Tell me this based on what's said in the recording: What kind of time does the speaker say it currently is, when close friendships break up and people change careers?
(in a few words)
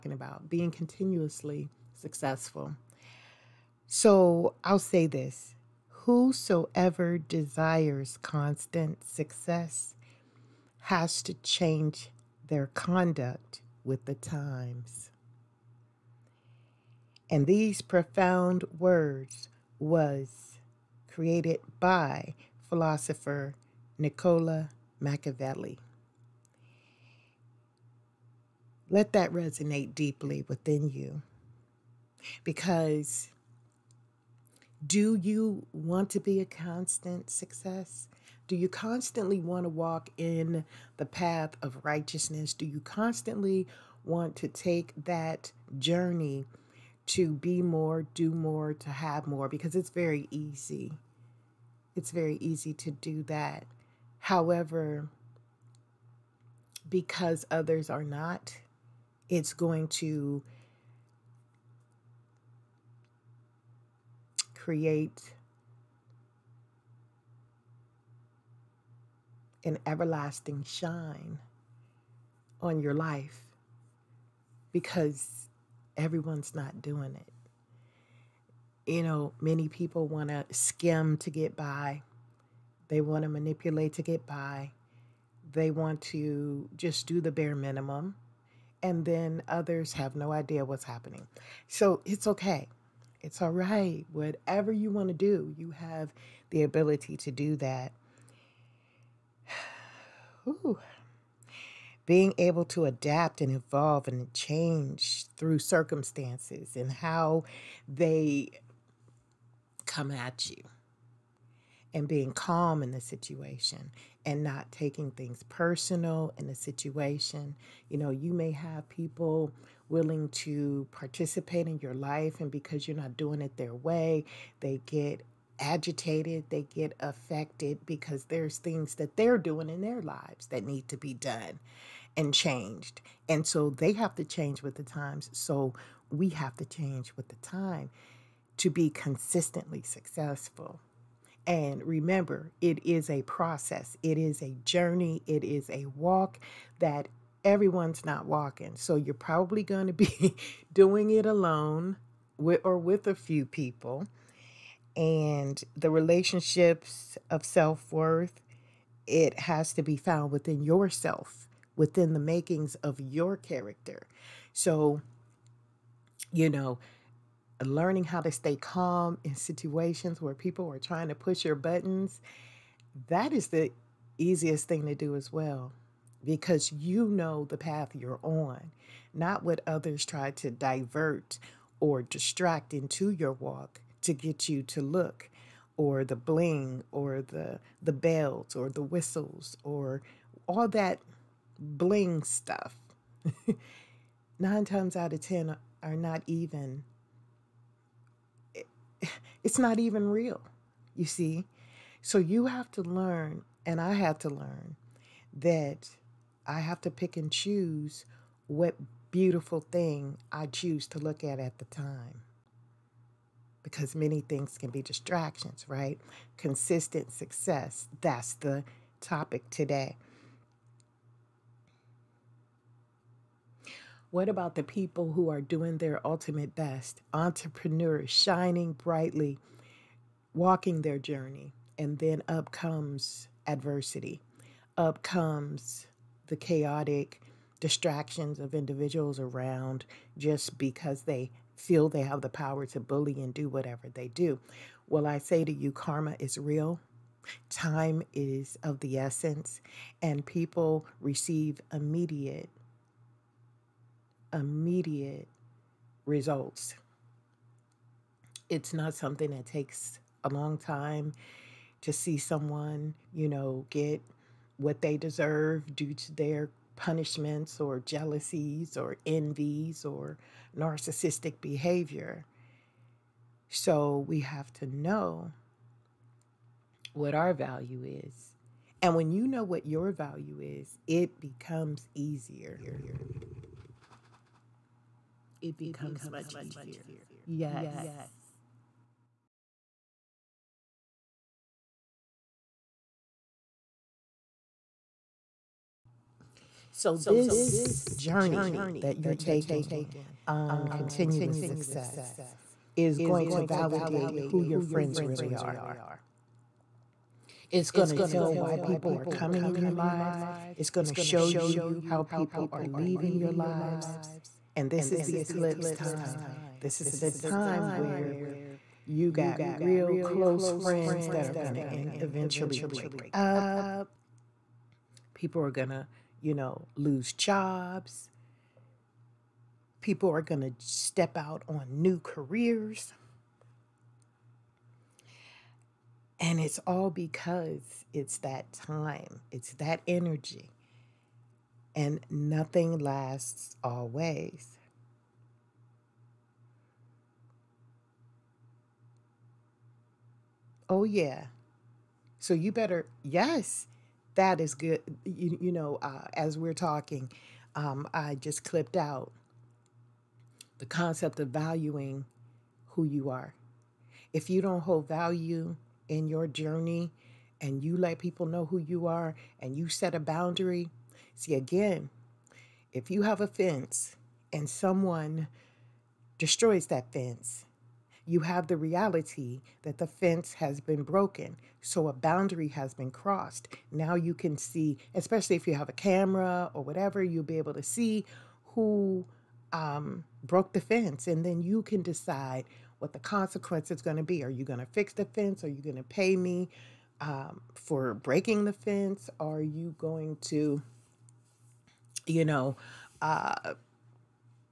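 eclipse time.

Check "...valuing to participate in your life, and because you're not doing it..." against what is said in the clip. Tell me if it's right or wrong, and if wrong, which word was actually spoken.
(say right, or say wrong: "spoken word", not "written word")
wrong: "willing", not "valuing".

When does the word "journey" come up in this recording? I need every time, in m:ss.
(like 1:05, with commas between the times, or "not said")
0:45, 2:24, 3:50, 4:57, 6:06.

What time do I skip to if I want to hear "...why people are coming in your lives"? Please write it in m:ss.
5:08.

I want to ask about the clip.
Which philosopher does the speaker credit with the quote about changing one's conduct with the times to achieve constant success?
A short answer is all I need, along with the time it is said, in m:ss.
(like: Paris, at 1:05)
Nicola Machiavelli, at 0:23.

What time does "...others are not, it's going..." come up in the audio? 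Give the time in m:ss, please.
0:57.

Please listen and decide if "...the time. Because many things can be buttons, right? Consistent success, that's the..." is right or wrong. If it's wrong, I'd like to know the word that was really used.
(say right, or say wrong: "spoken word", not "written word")
wrong: "distractions", not "buttons".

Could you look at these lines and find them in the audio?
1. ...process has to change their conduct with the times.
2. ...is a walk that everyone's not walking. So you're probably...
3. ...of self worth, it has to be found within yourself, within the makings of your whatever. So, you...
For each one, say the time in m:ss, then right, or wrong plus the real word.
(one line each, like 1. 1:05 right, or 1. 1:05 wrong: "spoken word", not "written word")
1. 0:09 wrong: "success", not "process"
2. 2:25 right
3. 2:37 wrong: "character", not "whatever".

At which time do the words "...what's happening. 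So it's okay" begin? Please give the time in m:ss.
1:30.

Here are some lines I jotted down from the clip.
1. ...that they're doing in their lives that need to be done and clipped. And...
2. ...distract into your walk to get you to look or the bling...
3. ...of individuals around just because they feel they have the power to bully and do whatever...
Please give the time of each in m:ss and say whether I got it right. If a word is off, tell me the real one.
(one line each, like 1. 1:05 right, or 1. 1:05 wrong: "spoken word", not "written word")
1. 2:08 wrong: "changed", not "clipped"
2. 3:02 right
3. 3:58 right.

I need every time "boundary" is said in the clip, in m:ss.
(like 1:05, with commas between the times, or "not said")
6:09, 6:21.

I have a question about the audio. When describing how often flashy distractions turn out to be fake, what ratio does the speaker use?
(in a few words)
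9 times out of 10.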